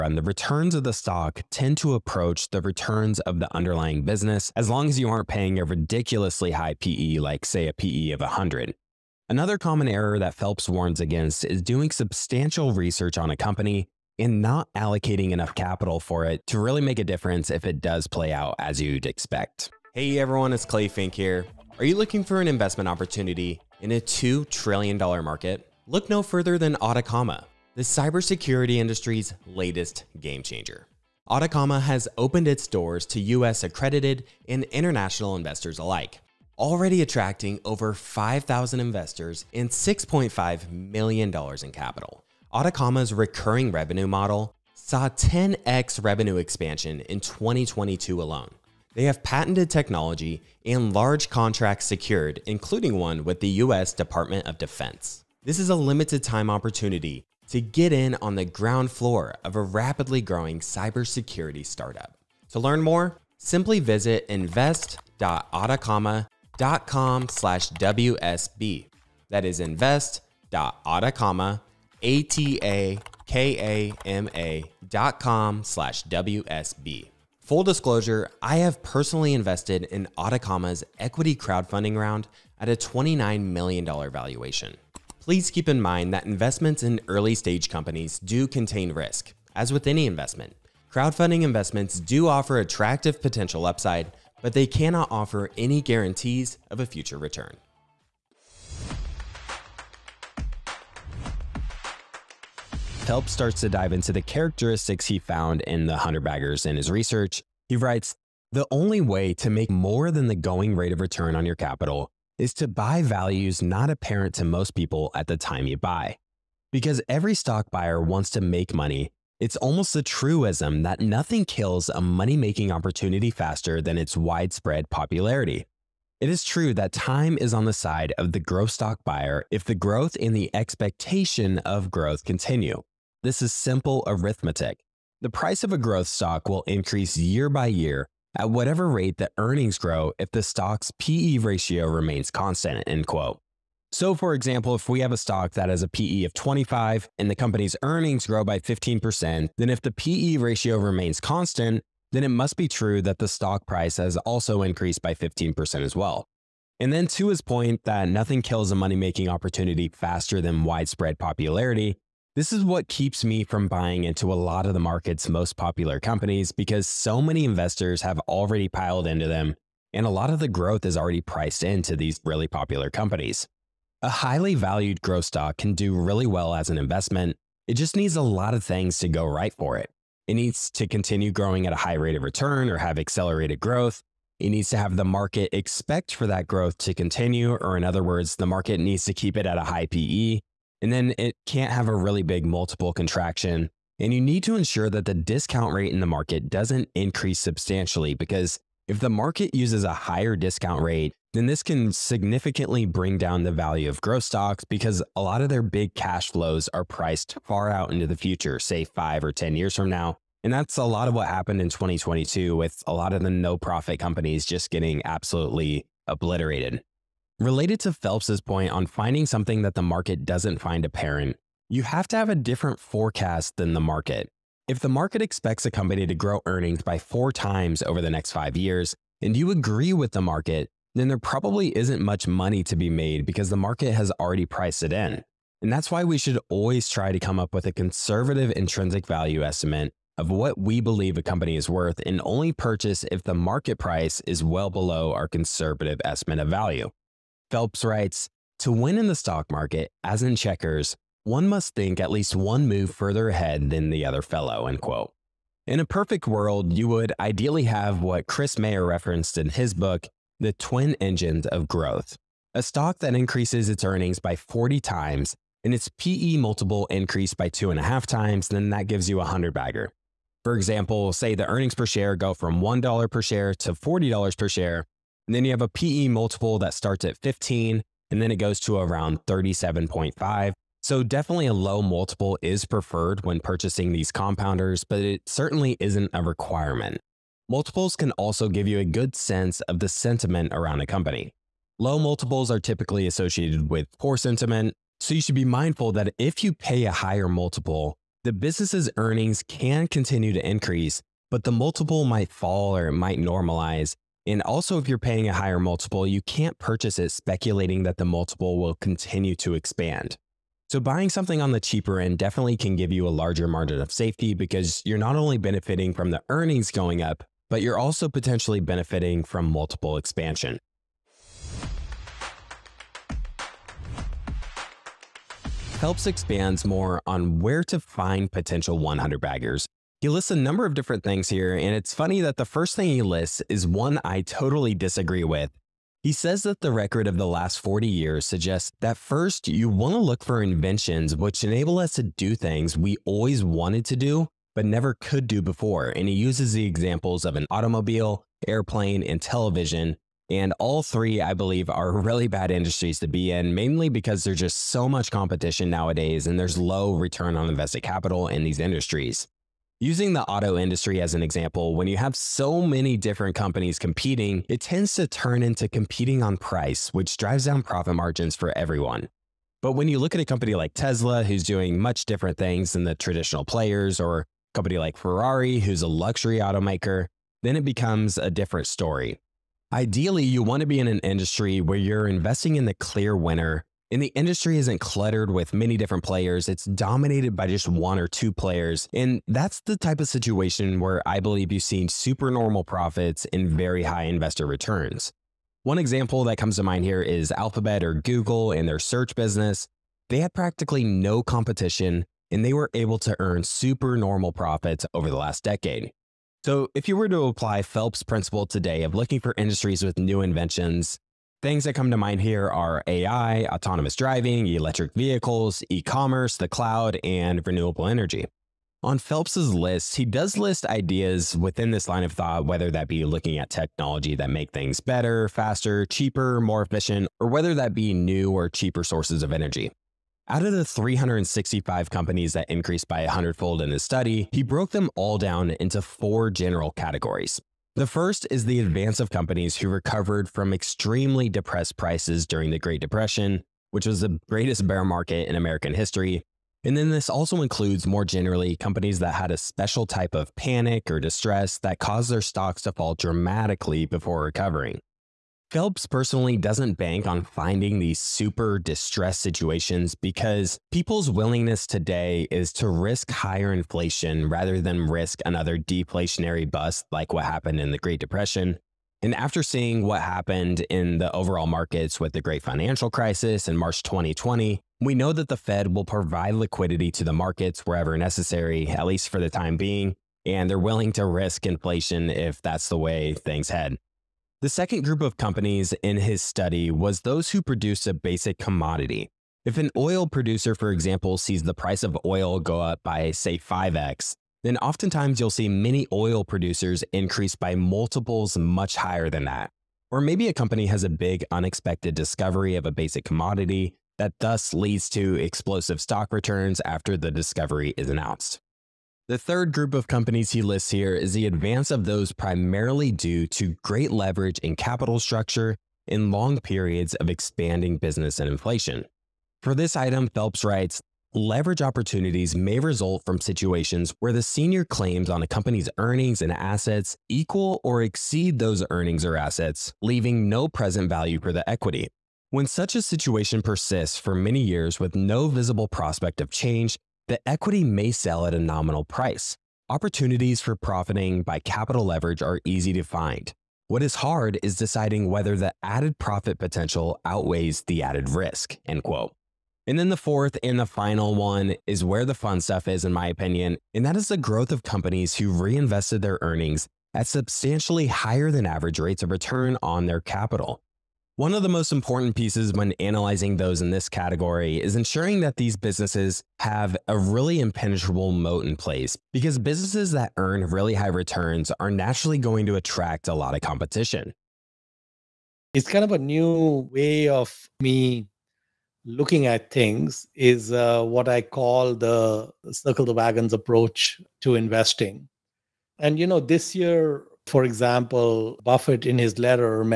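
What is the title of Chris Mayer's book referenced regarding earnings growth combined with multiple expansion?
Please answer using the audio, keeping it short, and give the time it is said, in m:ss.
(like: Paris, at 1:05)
The Twin Engines of Growth, at 4:20.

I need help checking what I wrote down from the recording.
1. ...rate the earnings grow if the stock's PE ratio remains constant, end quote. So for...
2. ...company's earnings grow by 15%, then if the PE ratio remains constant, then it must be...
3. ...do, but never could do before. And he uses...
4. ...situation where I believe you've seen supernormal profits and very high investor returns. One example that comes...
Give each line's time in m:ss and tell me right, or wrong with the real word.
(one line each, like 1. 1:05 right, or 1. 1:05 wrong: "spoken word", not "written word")
1. 2:18 right
2. 2:27 right
3. 5:43 right
4. 6:30 right.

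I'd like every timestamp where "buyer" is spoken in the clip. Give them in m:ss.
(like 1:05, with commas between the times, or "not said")
1:57, 2:09.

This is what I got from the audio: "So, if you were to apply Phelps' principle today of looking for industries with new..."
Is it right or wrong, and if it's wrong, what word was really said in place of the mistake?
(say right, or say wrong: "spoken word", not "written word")
right.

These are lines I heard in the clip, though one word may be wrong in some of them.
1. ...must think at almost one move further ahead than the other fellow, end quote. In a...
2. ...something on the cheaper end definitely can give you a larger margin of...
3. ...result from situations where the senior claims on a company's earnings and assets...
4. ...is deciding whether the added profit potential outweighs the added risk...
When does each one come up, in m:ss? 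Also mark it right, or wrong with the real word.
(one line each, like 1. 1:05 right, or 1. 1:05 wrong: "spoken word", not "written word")
1. 4:11 wrong: "least", not "almost"
2. 5:11 right
3. 8:42 right
4. 9:04 right.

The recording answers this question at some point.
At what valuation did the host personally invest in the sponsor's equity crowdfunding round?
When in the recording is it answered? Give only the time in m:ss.
1:22.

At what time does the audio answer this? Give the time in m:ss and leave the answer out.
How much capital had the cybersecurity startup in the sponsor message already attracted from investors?
0:39.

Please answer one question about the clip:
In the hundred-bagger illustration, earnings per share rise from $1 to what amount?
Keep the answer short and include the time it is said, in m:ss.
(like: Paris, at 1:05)
$40 per share, at 4:33.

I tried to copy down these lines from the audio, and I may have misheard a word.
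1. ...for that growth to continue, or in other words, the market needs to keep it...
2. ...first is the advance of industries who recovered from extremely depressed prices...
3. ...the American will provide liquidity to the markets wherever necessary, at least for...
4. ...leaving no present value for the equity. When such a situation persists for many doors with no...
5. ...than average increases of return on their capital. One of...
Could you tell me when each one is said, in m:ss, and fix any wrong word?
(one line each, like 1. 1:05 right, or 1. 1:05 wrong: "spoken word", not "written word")
1. 3:06 right
2. 7:17 wrong: "companies", not "industries"
3. 7:55 wrong: "Fed", not "American"
4. 8:49 wrong: "years", not "doors"
5. 9:18 wrong: "rates", not "increases".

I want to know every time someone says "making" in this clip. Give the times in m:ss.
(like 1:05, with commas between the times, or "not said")
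2:02, 2:38.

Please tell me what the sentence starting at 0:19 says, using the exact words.
Hey everyone, it's Clay Fink here.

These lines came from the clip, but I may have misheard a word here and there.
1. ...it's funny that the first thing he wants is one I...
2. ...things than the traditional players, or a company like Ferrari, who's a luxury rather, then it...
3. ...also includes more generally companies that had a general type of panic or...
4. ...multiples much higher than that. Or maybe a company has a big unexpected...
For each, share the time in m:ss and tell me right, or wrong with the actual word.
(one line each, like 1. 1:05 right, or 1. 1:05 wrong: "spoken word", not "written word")
1. 5:31 wrong: "lists", not "wants"
2. 6:12 wrong: "automaker", not "rather"
3. 7:27 wrong: "special", not "general"
4. 8:17 right.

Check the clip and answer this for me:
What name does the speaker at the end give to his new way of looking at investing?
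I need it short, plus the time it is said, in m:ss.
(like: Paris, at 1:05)
circle the wagons approach, at 9:42.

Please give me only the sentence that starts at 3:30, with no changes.
And that's a lot of what happened in 2022 with a lot of the no profit companies just getting absolutely obliterated.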